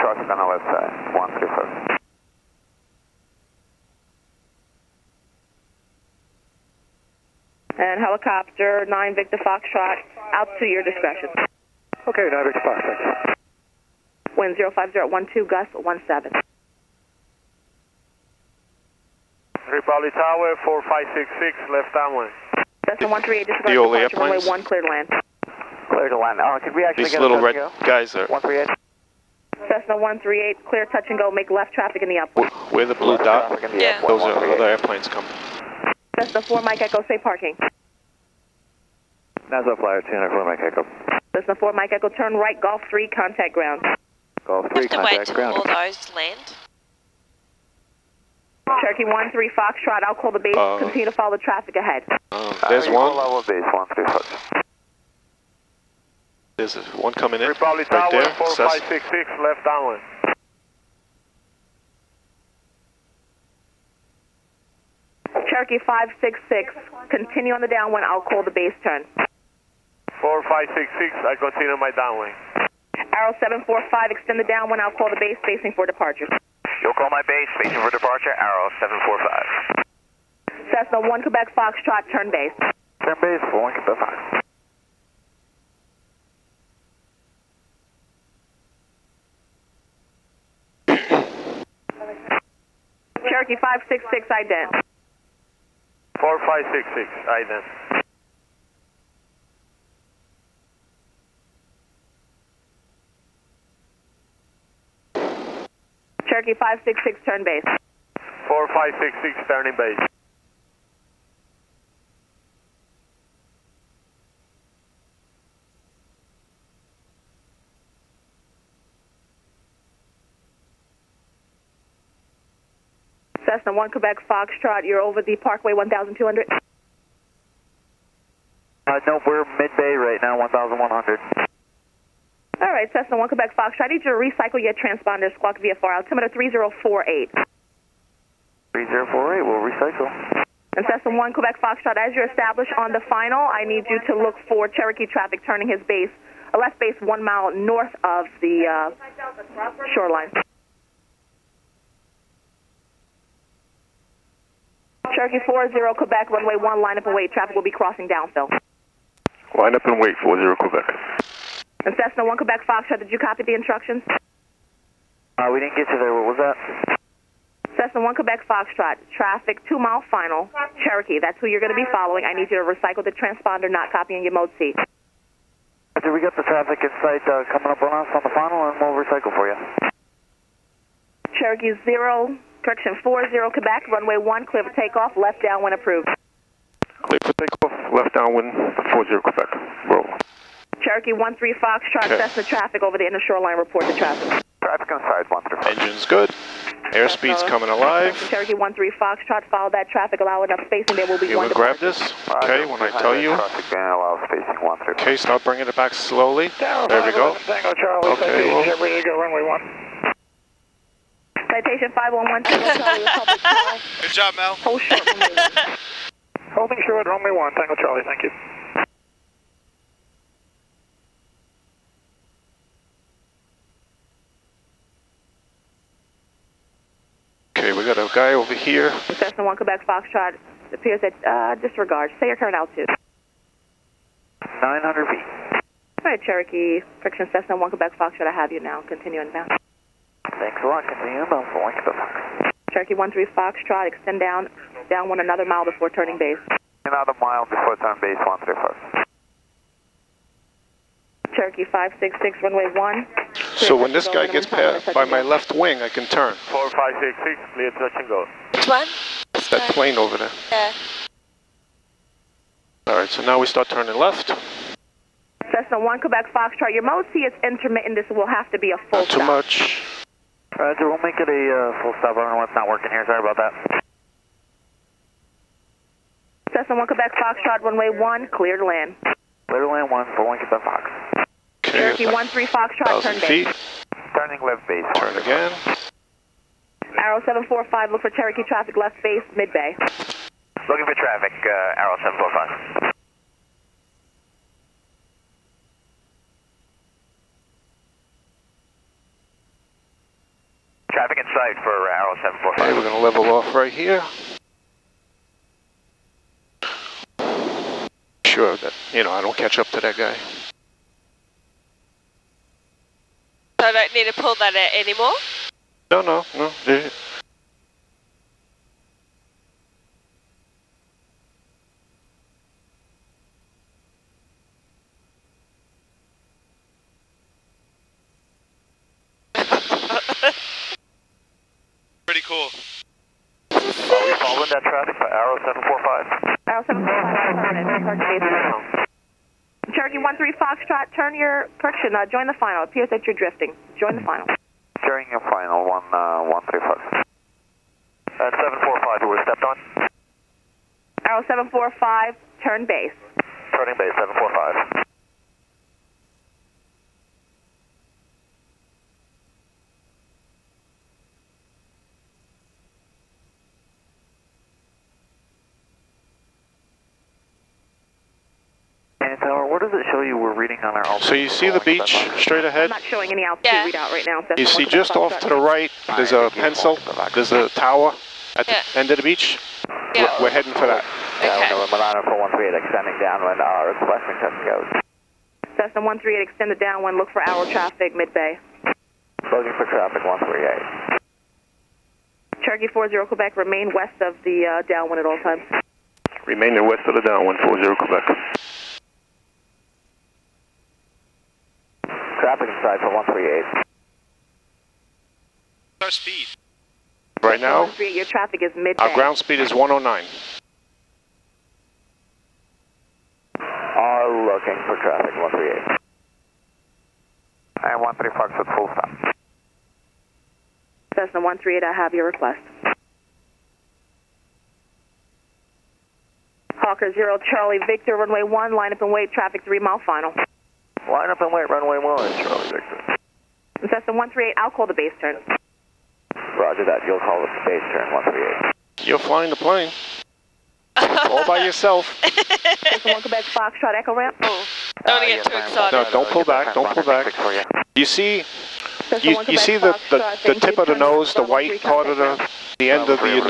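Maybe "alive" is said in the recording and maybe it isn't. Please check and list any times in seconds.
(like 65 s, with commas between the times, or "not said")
197 s.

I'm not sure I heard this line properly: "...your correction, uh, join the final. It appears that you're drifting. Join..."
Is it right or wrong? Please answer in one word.
right.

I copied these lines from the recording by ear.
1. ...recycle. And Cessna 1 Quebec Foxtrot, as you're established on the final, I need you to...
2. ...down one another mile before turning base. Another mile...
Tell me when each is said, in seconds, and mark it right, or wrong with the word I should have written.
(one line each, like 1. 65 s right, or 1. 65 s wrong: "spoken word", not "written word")
1. 139 s right
2. 244 s right.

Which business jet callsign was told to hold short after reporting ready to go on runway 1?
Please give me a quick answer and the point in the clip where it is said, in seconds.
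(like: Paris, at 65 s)
Citation 5112 Charlie, at 211 s.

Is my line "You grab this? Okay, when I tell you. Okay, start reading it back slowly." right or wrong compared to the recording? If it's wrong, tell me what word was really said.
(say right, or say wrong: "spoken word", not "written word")
wrong: "bringing", not "reading".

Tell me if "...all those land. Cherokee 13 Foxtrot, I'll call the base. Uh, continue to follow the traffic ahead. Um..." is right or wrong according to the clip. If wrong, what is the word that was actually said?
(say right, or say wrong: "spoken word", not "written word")
right.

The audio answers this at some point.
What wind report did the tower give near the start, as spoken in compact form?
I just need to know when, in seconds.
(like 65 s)
14 s.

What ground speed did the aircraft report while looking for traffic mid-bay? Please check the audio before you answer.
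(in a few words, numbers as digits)
109.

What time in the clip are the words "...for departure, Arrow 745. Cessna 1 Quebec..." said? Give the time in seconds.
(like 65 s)
77 s.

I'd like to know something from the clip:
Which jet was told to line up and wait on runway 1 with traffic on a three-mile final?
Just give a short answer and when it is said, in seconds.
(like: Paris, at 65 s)
Hawker 0 Charlie Victor, at 426 s.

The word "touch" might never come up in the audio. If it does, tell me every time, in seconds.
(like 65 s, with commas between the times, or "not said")
30 s, 257 s.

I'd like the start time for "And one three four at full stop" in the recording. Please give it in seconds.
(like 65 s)
417 s.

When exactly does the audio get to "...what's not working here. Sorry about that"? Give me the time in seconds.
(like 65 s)
272 s.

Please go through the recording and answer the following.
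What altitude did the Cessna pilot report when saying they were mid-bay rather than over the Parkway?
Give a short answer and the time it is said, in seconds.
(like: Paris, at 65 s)
1100, at 130 s.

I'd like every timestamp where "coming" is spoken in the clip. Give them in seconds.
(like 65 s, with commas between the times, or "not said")
35 s, 57 s, 177 s, 197 s.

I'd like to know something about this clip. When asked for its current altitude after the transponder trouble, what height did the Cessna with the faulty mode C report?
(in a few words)
900 feet.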